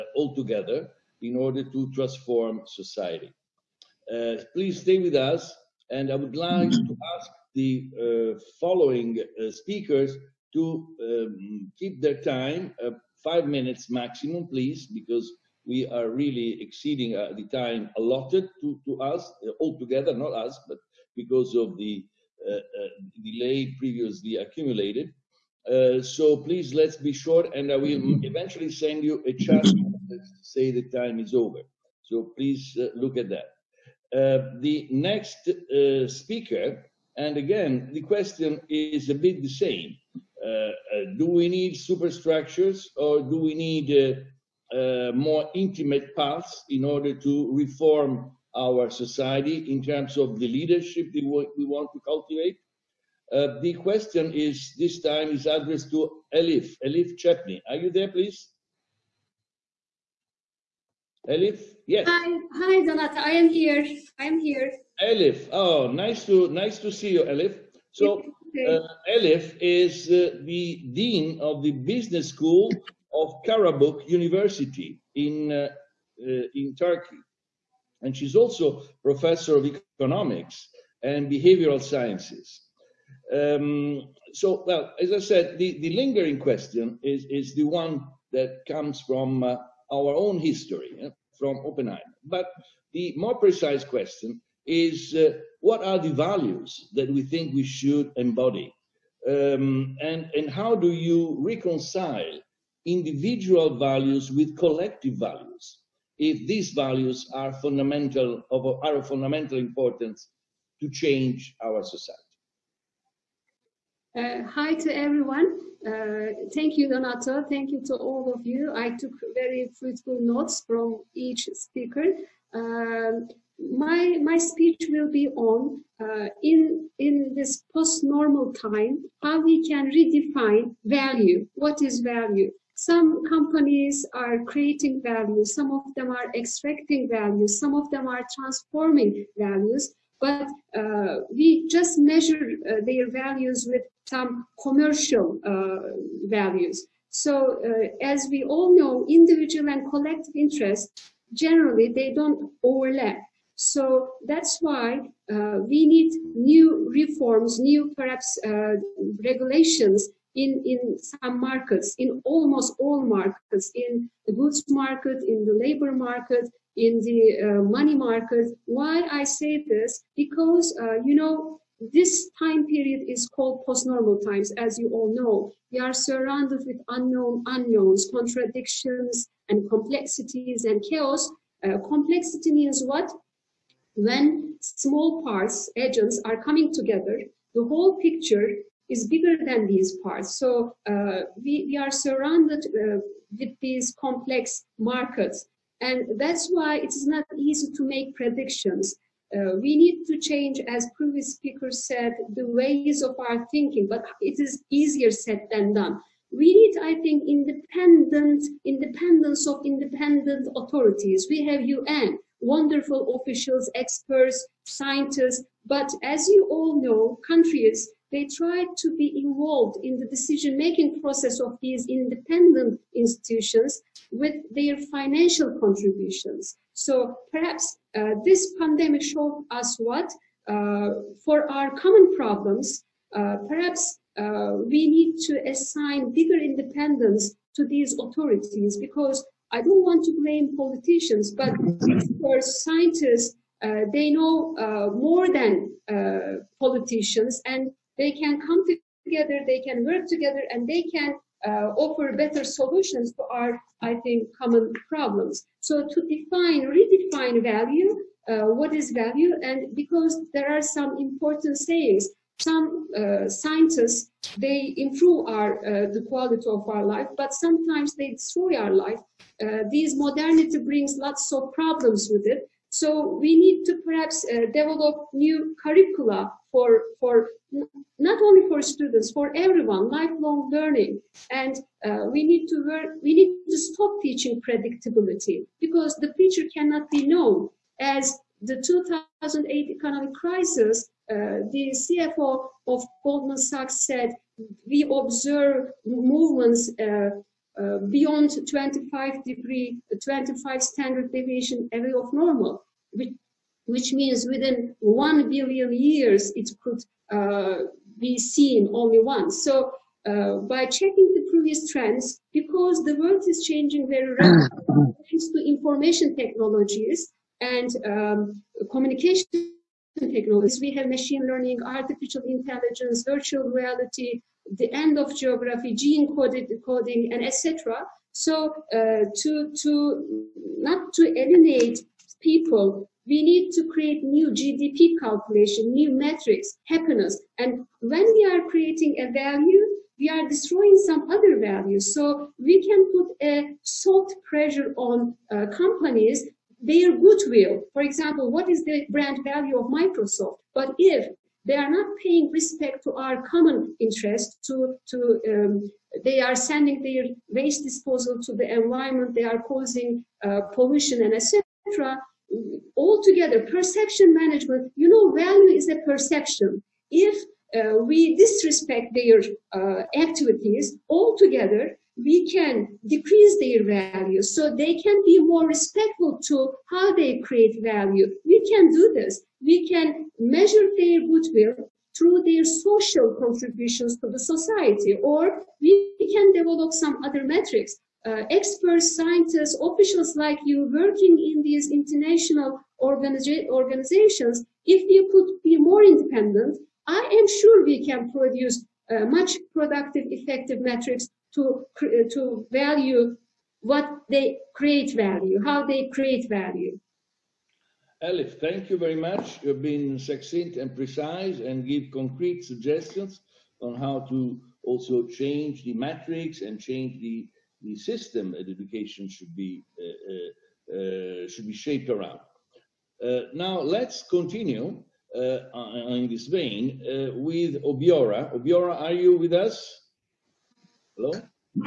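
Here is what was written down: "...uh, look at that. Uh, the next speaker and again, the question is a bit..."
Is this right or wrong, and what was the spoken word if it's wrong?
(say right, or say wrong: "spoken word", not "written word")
right.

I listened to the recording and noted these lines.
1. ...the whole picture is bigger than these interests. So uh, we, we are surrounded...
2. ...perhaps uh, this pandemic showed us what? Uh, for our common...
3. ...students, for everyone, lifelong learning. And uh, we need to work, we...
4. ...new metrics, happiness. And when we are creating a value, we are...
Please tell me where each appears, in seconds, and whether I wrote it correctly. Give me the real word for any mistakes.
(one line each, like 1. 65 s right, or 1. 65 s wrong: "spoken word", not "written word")
1. 187 s wrong: "parts", not "interests"
2. 227 s right
3. 278 s right
4. 335 s right.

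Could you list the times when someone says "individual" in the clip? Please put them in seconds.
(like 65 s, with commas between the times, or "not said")
102 s, 149 s.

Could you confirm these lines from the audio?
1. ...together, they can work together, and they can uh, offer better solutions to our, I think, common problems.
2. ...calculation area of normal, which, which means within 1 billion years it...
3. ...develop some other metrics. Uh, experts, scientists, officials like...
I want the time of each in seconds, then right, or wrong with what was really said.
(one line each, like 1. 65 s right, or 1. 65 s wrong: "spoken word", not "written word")
1. 249 s right
2. 301 s wrong: "deviation", not "calculation"
3. 386 s right.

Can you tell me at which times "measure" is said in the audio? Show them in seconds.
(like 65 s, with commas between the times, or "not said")
141 s, 380 s.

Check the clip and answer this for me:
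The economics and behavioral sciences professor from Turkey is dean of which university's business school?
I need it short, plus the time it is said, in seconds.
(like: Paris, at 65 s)
Karabuk University, at 73 s.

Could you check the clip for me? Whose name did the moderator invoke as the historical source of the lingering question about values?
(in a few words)
Oppenheimer.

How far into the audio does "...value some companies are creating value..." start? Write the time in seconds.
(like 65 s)
132 s.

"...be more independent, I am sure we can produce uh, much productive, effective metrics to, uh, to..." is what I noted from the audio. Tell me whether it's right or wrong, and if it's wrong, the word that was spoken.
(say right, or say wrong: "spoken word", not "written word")
right.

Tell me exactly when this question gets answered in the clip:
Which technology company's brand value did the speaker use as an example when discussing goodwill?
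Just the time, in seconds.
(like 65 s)
349 s.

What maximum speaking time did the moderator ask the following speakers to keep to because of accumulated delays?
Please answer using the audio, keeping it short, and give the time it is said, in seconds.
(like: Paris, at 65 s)
5 minutes, at 13 s.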